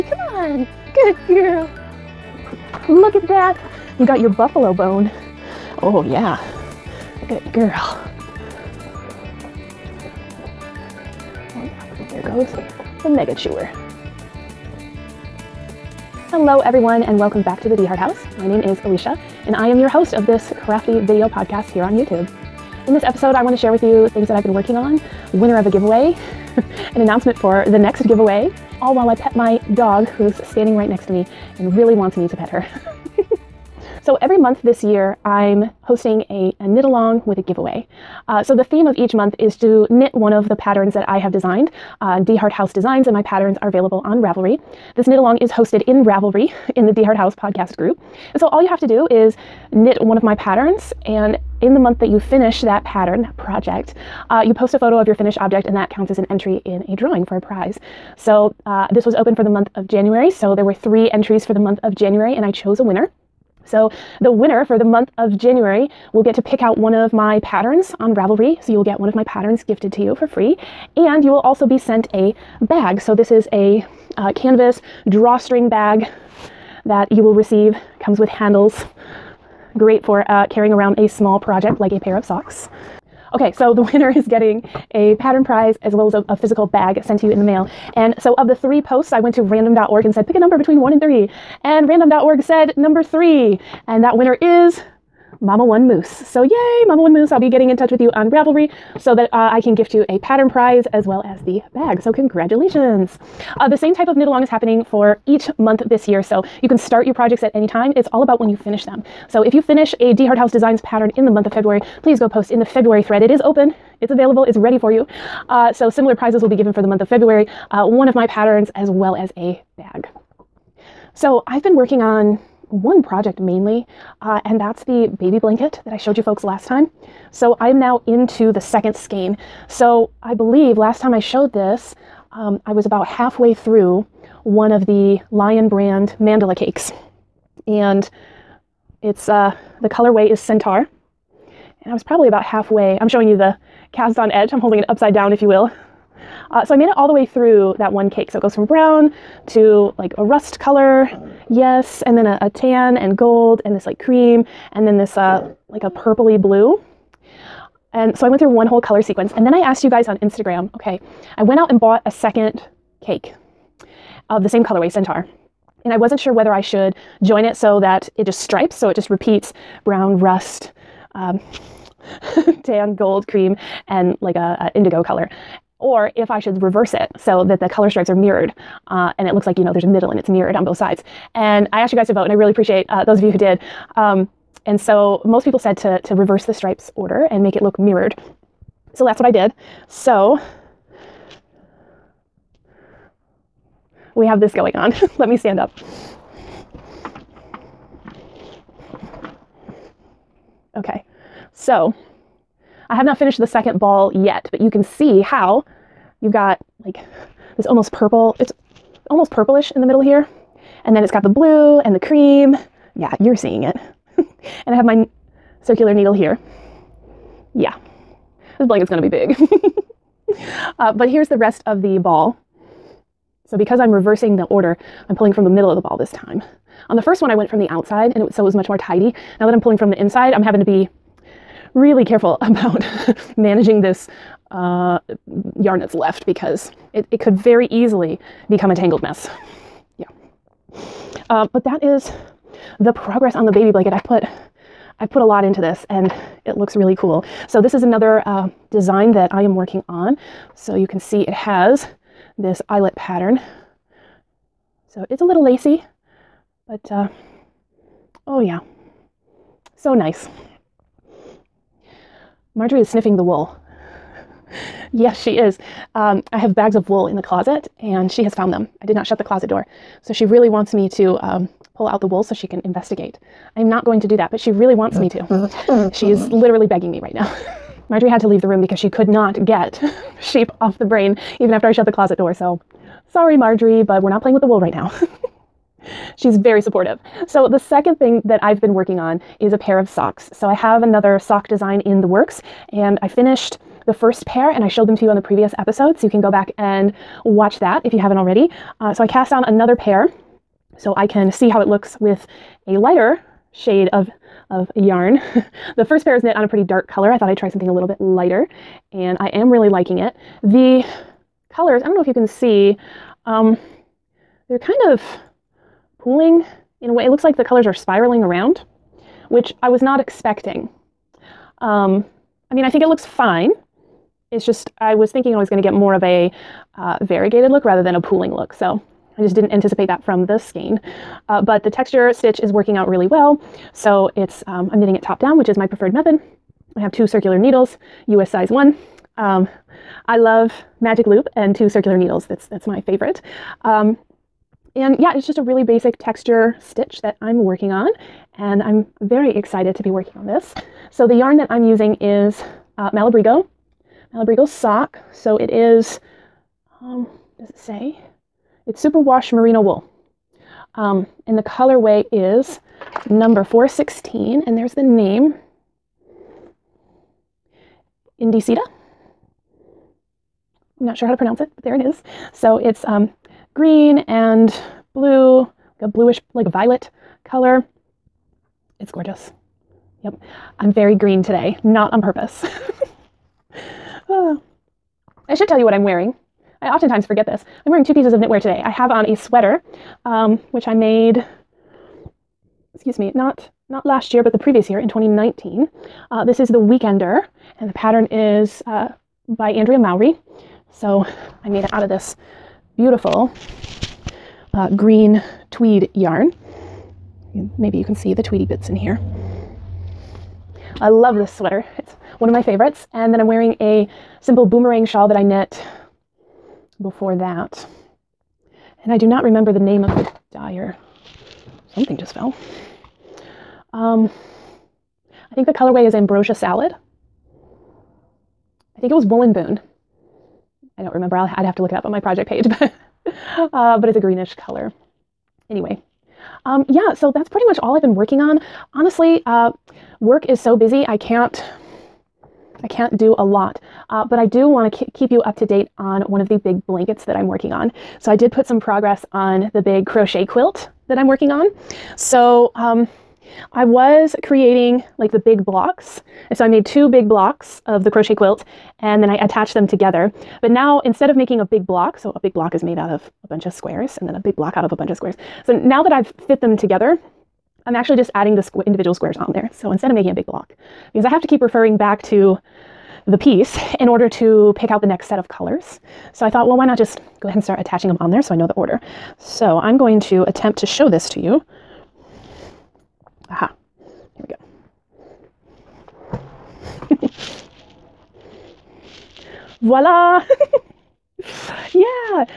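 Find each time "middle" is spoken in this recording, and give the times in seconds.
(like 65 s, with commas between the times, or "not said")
179 s, 209 s, 225 s.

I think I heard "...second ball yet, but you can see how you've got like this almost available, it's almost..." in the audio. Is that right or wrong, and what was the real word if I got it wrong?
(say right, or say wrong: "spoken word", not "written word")
wrong: "purple", not "available".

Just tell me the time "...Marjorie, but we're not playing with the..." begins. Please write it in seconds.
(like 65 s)
283 s.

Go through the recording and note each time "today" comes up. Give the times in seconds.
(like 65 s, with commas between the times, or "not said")
381 s, 388 s.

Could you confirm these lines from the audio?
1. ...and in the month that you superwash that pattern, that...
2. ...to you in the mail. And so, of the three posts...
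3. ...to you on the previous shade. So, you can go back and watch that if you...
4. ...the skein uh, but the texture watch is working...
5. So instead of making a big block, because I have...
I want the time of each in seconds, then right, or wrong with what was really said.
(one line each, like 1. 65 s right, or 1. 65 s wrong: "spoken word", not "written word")
1. 51 s wrong: "finish", not "superwash"
2. 87 s right
3. 294 s wrong: "episode", not "shade"
4. 330 s wrong: "stitch", not "watch"
5. 469 s right.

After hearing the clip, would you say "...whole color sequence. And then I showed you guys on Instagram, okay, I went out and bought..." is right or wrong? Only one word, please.
wrong.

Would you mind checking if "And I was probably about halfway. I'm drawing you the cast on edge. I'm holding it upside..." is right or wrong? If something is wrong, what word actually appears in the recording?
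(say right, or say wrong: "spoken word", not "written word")
wrong: "showing", not "drawing".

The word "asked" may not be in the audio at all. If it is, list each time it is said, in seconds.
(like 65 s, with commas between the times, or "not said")
159 s, 181 s.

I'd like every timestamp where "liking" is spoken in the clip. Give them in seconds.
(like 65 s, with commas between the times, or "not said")
309 s.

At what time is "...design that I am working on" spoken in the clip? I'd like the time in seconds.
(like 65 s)
248 s.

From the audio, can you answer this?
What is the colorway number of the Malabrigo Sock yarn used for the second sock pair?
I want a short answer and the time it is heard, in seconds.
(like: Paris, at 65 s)
416, at 363 s.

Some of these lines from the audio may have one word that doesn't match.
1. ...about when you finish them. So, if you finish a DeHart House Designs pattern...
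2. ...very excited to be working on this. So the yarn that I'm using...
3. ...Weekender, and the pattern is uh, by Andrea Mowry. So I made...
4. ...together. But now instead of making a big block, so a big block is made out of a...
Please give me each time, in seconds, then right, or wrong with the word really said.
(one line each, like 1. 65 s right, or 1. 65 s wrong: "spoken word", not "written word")
1. 108 s right
2. 349 s right
3. 396 s right
4. 459 s right.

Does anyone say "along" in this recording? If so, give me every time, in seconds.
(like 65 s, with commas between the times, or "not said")
36 s, 45 s, 104 s.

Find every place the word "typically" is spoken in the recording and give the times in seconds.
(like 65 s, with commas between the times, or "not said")
not said.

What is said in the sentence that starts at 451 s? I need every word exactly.
So, um, I was creating like the big blocks.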